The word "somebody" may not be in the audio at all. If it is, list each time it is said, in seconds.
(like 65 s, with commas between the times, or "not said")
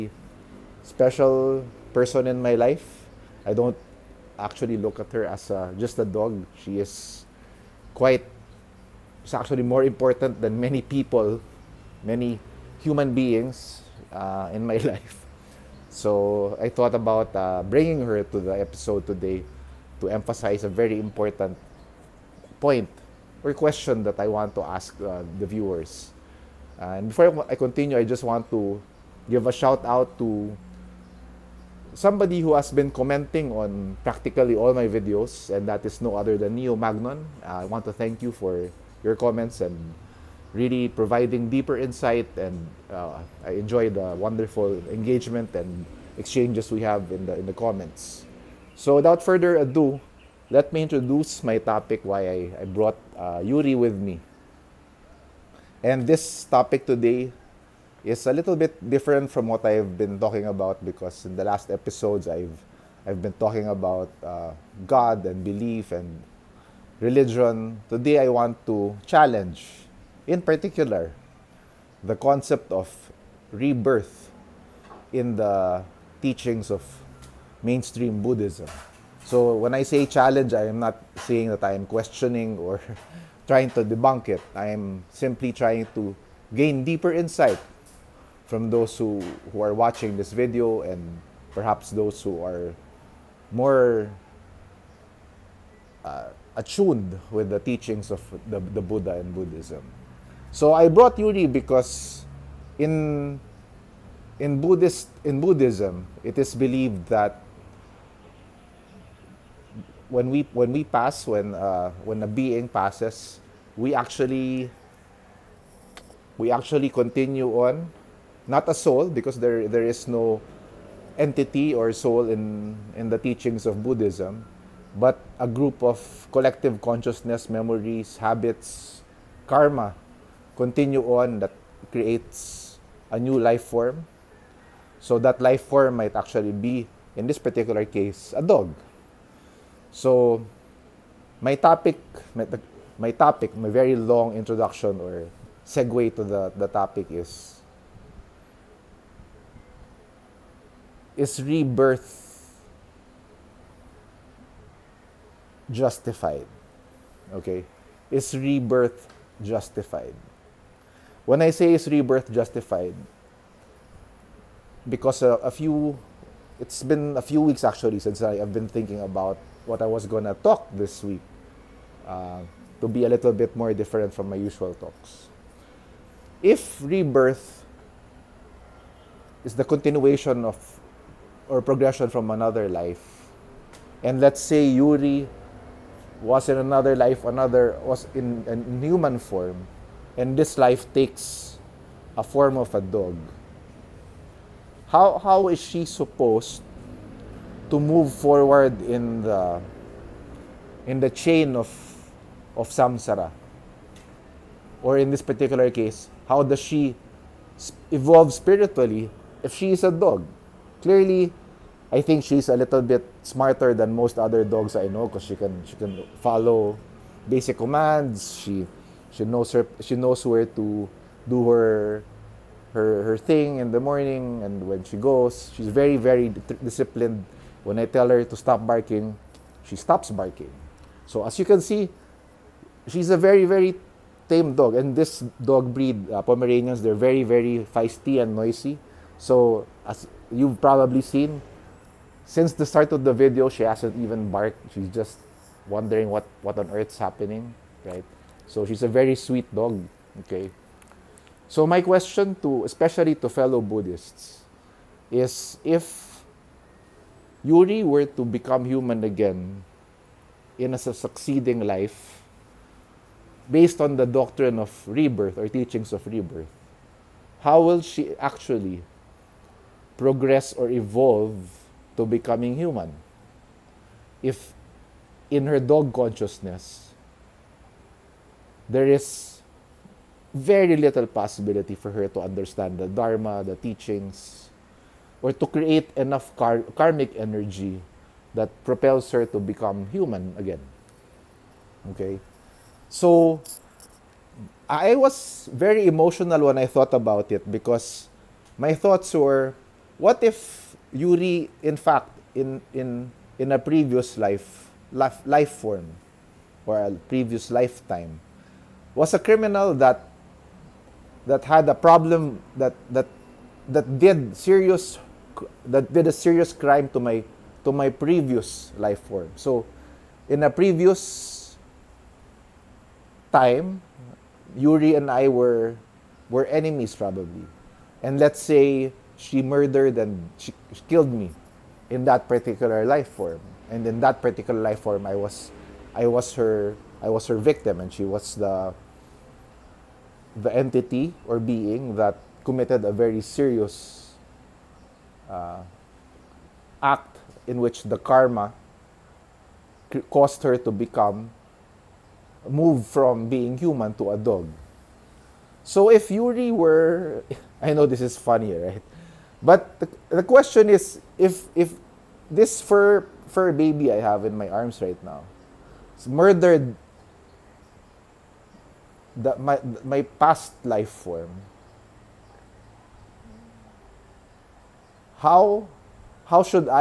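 31 s.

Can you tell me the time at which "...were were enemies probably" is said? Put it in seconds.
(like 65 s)
325 s.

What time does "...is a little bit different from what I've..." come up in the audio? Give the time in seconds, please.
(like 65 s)
58 s.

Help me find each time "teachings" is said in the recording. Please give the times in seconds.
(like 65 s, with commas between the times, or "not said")
76 s, 97 s, 123 s, 265 s, 283 s.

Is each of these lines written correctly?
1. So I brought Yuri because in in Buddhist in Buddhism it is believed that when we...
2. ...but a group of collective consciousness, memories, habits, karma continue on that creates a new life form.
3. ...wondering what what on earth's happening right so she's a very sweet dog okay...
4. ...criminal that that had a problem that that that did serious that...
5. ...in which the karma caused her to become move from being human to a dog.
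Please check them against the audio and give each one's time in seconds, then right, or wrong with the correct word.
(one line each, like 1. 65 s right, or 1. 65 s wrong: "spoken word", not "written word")
1. 100 s right
2. 124 s right
3. 245 s right
4. 309 s right
5. 347 s right.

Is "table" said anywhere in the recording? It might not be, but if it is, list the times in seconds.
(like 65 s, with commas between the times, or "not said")
not said.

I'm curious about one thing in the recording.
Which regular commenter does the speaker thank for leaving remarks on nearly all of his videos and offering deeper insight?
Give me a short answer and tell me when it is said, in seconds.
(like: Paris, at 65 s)
Neo Magnon, at 36 s.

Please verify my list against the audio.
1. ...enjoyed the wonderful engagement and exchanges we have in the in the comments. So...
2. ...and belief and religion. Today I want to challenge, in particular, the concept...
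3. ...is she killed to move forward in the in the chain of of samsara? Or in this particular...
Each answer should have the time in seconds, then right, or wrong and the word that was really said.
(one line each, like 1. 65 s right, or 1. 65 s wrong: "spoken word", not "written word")
1. 43 s right
2. 65 s right
3. 195 s wrong: "supposed", not "killed".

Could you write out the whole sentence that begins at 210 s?
clearly, I think she's a little bit smarter than most other dogs I know because she can she can follow basic commands.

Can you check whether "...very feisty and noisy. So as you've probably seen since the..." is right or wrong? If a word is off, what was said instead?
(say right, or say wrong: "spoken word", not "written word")
right.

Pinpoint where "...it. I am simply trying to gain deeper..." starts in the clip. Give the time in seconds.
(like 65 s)
84 s.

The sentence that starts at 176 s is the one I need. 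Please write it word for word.
If rebirth is the continuation of or progression from another life.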